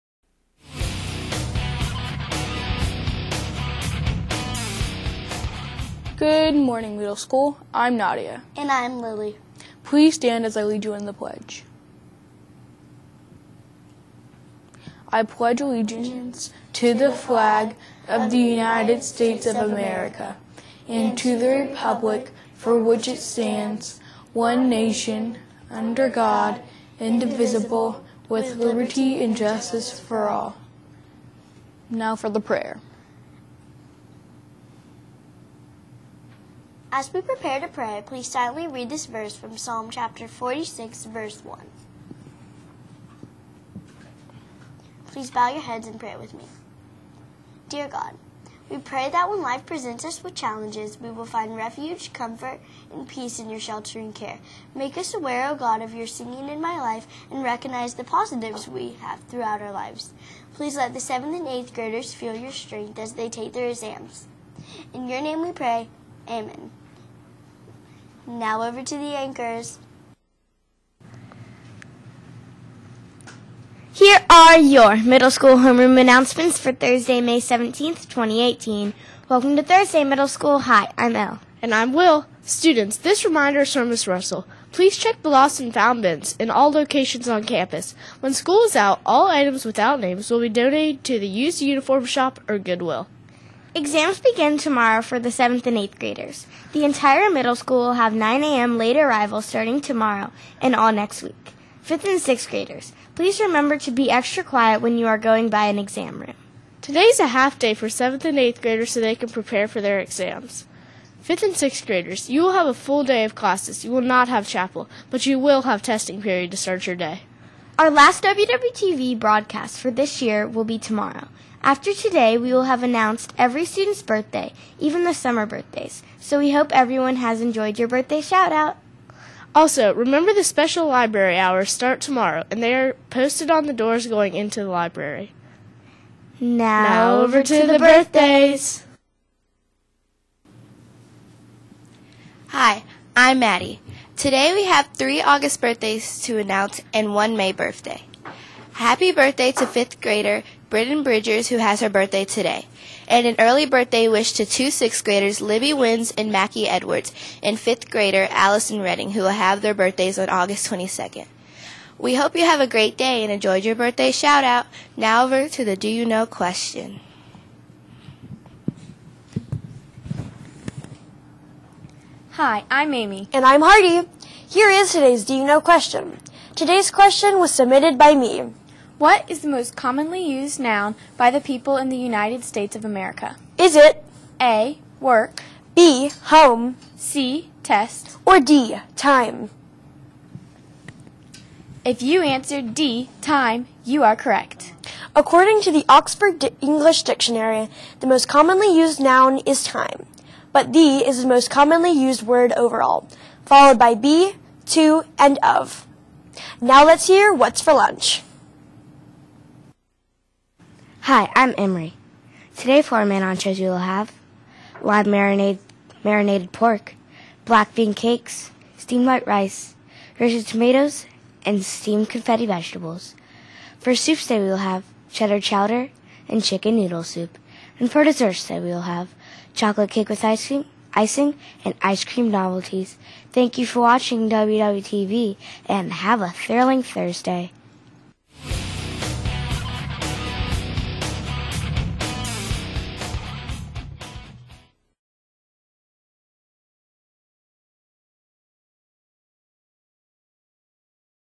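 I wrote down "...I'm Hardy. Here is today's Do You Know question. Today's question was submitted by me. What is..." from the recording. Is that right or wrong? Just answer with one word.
right.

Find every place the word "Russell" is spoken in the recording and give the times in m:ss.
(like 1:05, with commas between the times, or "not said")
1:24.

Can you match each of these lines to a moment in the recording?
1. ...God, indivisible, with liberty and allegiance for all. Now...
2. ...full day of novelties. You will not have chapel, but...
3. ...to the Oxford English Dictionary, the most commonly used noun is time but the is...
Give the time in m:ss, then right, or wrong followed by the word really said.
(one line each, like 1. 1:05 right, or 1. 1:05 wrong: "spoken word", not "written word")
1. 0:26 wrong: "justice", not "allegiance"
2. 1:52 wrong: "classes", not "novelties"
3. 3:15 right.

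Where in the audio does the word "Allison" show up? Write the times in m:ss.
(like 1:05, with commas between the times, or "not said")
2:38.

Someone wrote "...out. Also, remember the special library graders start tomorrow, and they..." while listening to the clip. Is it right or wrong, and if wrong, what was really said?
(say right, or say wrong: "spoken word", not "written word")
wrong: "hours", not "graders".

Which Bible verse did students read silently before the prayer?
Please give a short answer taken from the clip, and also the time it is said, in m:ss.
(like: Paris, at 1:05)
Psalm 46:1, at 0:39.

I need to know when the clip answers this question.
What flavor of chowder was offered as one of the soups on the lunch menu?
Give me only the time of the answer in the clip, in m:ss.
3:45.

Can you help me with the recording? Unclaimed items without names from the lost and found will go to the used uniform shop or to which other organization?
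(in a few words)
Goodwill.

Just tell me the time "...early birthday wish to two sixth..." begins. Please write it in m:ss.
2:33.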